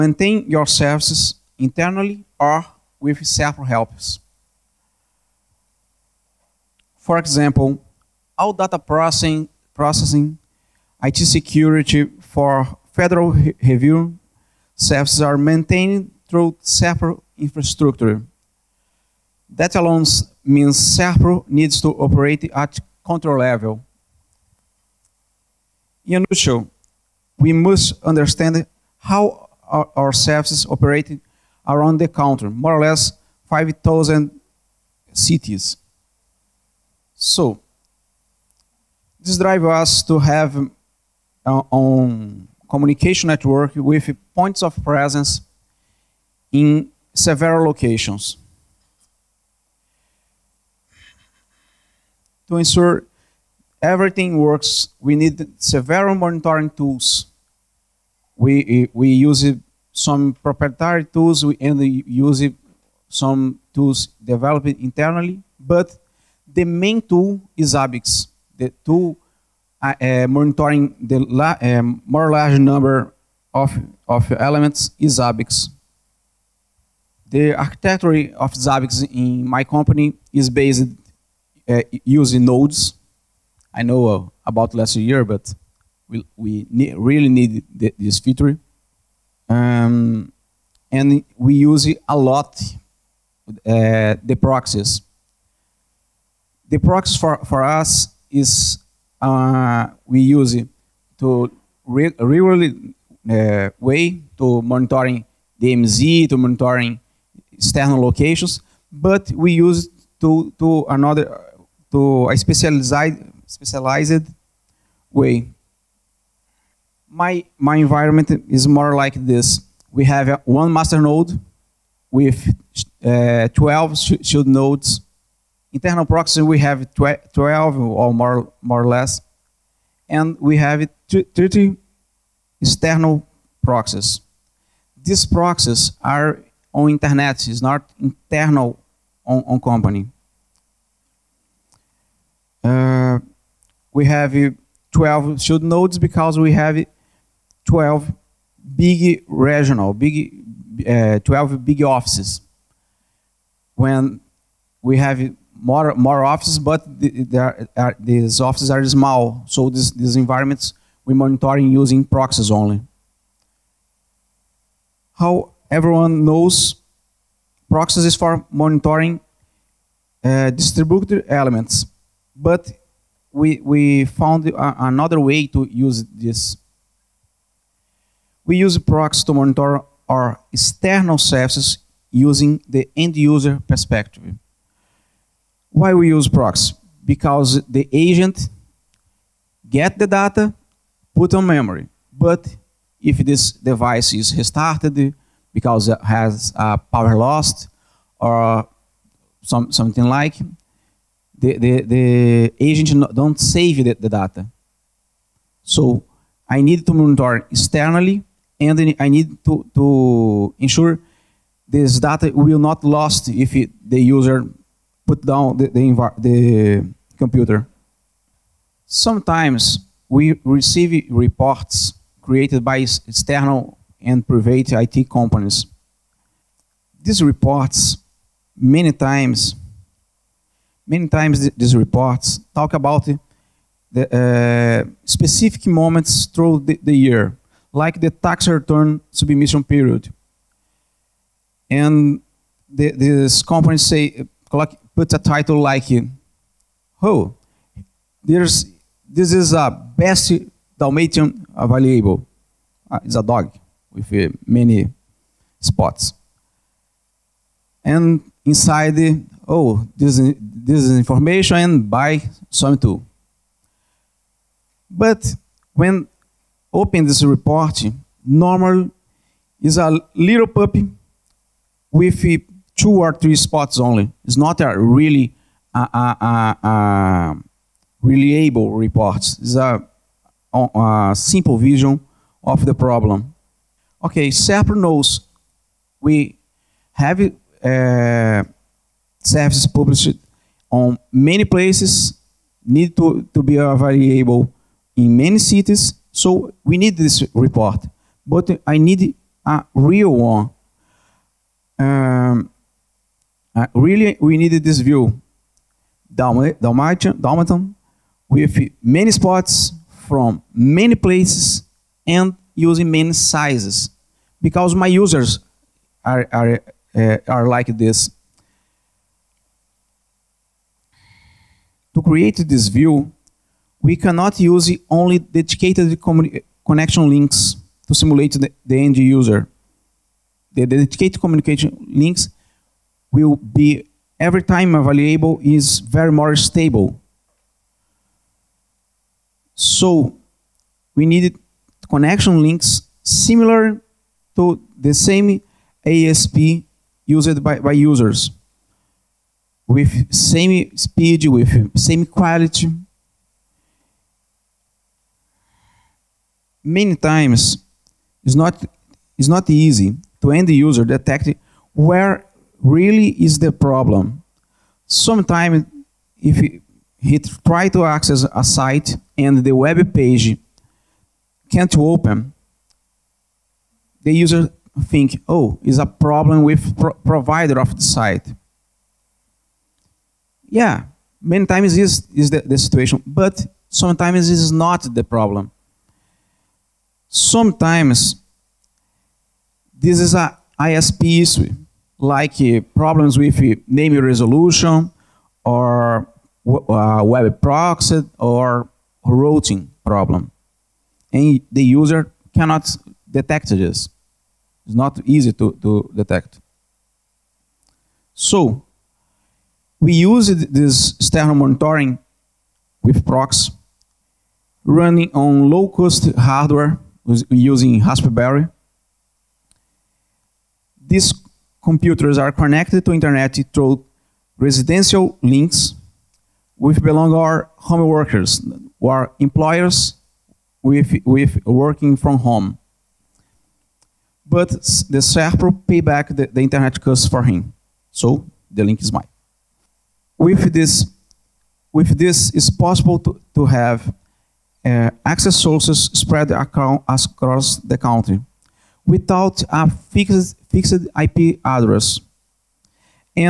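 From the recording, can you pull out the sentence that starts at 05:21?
To create this view, we cannot use only dedicated connection links to simulate the, the end user.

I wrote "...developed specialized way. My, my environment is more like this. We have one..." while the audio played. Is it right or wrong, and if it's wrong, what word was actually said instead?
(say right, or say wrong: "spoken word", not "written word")
wrong: "specialized", not "developed".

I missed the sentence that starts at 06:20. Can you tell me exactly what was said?
Yeah, many times is is the, the situation, but sometimes is not the problem.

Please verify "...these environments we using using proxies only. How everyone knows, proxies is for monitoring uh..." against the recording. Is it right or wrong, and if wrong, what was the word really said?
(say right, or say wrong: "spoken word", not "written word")
wrong: "monitoring", not "using".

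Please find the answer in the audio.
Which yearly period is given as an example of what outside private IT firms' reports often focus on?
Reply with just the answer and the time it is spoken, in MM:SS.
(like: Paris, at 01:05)
Tax return submission period, at 03:58.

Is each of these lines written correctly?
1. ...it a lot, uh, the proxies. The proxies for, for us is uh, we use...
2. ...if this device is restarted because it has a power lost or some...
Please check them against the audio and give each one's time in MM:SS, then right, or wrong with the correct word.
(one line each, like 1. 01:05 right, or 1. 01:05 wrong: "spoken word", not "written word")
1. 01:31 right
2. 03:13 right.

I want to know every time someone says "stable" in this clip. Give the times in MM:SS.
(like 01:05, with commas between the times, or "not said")
05:36.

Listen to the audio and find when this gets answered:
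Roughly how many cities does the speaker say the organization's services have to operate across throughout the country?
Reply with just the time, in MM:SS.
00:33.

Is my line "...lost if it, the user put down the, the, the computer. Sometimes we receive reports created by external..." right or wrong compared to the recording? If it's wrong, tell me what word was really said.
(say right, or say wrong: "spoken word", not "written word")
right.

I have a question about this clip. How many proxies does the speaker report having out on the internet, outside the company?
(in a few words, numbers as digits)
30.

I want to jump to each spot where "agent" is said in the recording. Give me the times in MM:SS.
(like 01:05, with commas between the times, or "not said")
03:07, 03:22.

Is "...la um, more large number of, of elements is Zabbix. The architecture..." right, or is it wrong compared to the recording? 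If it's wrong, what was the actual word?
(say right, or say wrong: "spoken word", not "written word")
right.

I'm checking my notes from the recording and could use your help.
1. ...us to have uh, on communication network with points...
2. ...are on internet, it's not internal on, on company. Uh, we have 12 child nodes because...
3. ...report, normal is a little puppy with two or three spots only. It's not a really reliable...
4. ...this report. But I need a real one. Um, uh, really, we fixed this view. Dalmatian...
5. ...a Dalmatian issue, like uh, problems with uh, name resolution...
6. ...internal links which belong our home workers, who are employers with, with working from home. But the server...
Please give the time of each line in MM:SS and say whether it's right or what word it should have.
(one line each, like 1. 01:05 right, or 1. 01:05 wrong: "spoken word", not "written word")
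1. 00:39 right
2. 02:16 right
3. 04:27 right
4. 04:56 wrong: "needed", not "fixed"
5. 06:30 wrong: "ISP", not "Dalmatian"
6. 07:04 wrong: "residential", not "internal".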